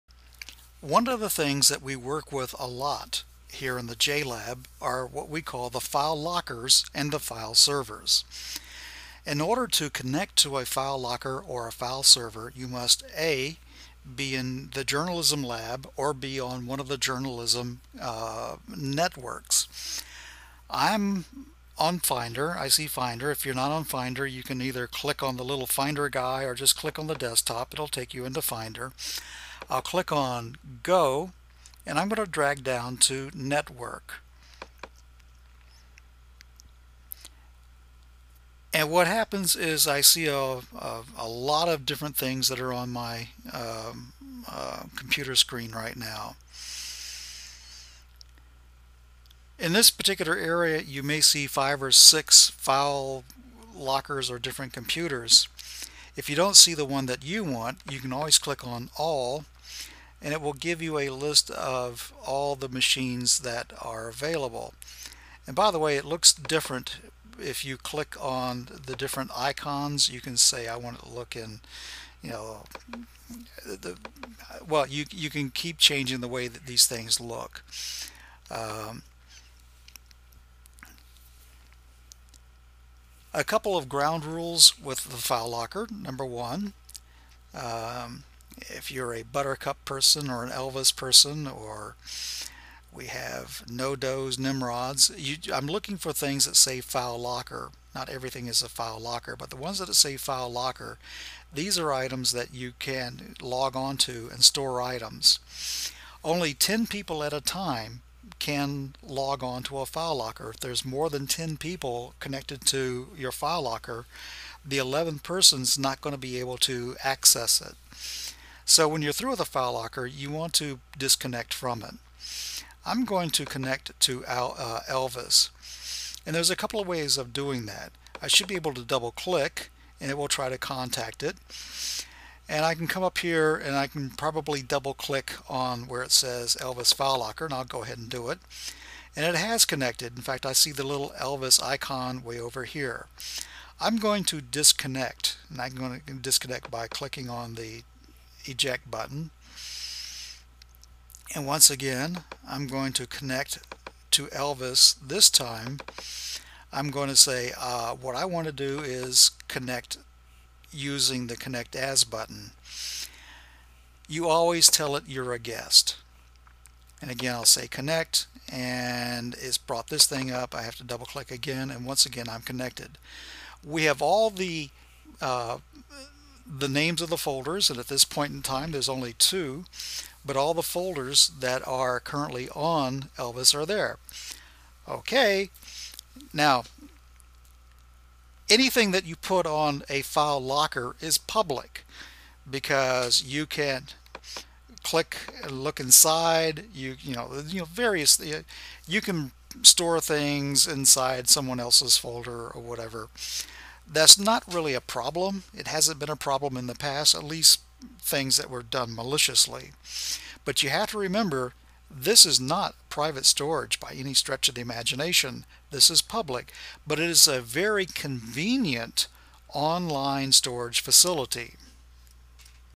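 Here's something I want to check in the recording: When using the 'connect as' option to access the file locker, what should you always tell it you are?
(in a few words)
guest.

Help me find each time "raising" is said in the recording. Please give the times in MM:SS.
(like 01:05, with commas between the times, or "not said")
not said.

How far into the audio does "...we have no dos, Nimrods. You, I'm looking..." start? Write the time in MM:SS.
01:32.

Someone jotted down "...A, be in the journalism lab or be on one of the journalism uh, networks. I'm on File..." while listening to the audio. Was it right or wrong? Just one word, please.
wrong.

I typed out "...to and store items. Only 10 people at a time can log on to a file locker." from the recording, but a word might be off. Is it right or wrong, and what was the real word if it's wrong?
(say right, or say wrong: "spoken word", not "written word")
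right.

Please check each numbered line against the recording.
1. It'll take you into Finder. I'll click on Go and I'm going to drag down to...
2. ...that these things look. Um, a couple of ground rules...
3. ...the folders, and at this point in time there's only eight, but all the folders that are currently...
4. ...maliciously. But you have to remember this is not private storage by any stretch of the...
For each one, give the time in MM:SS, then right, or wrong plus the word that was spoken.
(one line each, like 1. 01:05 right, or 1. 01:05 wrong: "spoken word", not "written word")
1. 00:27 right
2. 01:16 right
3. 02:57 wrong: "two", not "eight"
4. 03:28 right.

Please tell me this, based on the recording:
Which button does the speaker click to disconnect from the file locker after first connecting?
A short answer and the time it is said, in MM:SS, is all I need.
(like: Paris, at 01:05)
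eject button, at 02:28.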